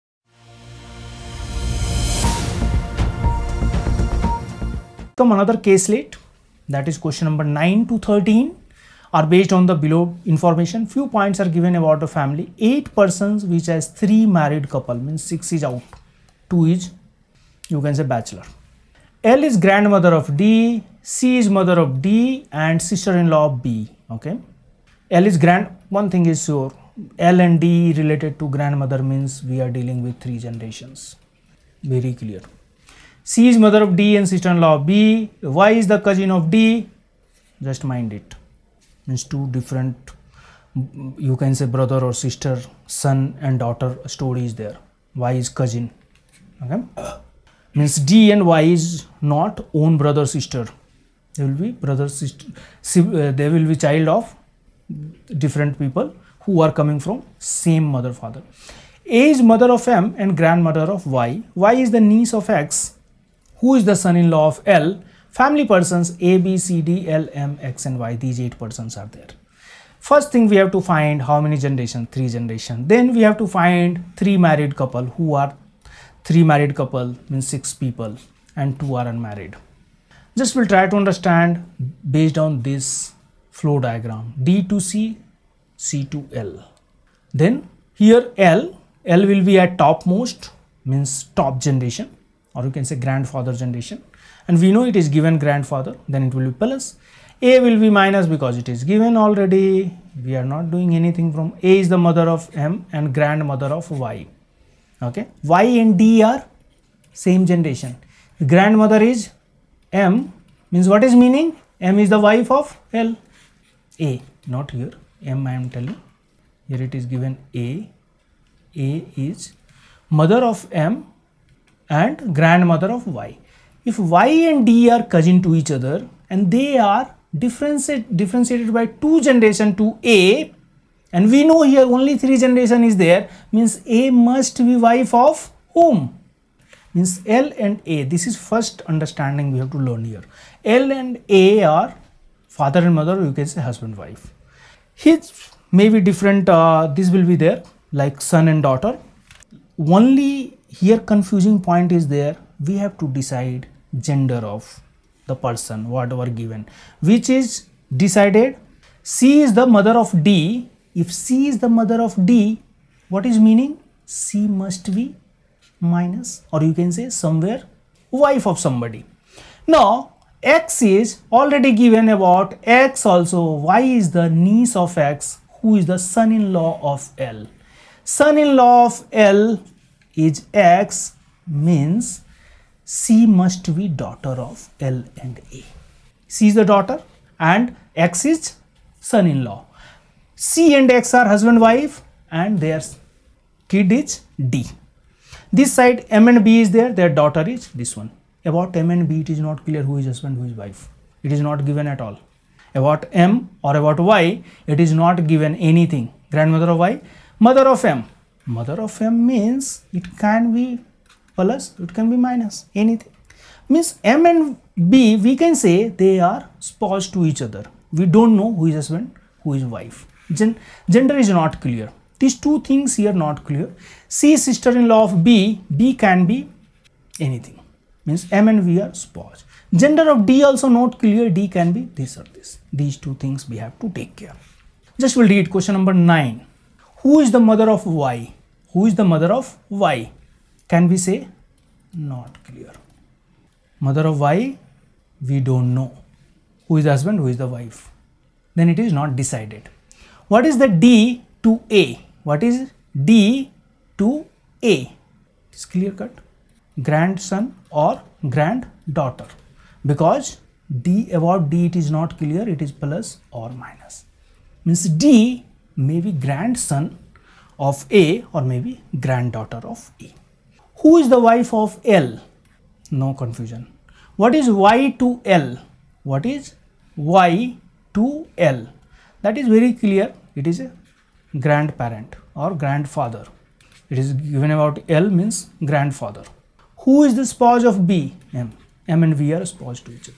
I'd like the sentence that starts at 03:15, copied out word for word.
This side M and B is there, their daughter is this one.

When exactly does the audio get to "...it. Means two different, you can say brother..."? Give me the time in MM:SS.
00:38.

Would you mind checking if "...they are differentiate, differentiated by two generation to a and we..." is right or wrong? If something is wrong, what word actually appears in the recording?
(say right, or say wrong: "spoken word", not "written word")
right.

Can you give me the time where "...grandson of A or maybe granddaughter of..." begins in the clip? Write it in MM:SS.
04:26.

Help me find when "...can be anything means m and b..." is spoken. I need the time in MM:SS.
03:45.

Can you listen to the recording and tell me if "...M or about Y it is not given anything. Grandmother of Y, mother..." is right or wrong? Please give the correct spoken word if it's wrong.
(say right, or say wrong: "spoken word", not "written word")
right.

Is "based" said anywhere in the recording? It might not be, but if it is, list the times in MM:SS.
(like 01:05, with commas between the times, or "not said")
00:09, 01:22.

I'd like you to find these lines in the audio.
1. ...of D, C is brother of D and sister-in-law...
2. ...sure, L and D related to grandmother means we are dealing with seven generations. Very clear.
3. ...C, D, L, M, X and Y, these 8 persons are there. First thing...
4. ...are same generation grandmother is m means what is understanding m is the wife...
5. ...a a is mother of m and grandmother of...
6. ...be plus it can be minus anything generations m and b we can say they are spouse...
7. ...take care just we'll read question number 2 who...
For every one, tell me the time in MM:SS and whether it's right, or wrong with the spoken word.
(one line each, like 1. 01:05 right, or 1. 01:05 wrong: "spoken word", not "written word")
1. 00:20 wrong: "mother", not "brother"
2. 00:26 wrong: "three", not "seven"
3. 01:06 right
4. 01:46 wrong: "meaning", not "understanding"
5. 01:57 right
6. 03:30 wrong: "means", not "generations"
7. 03:53 wrong: "9", not "2".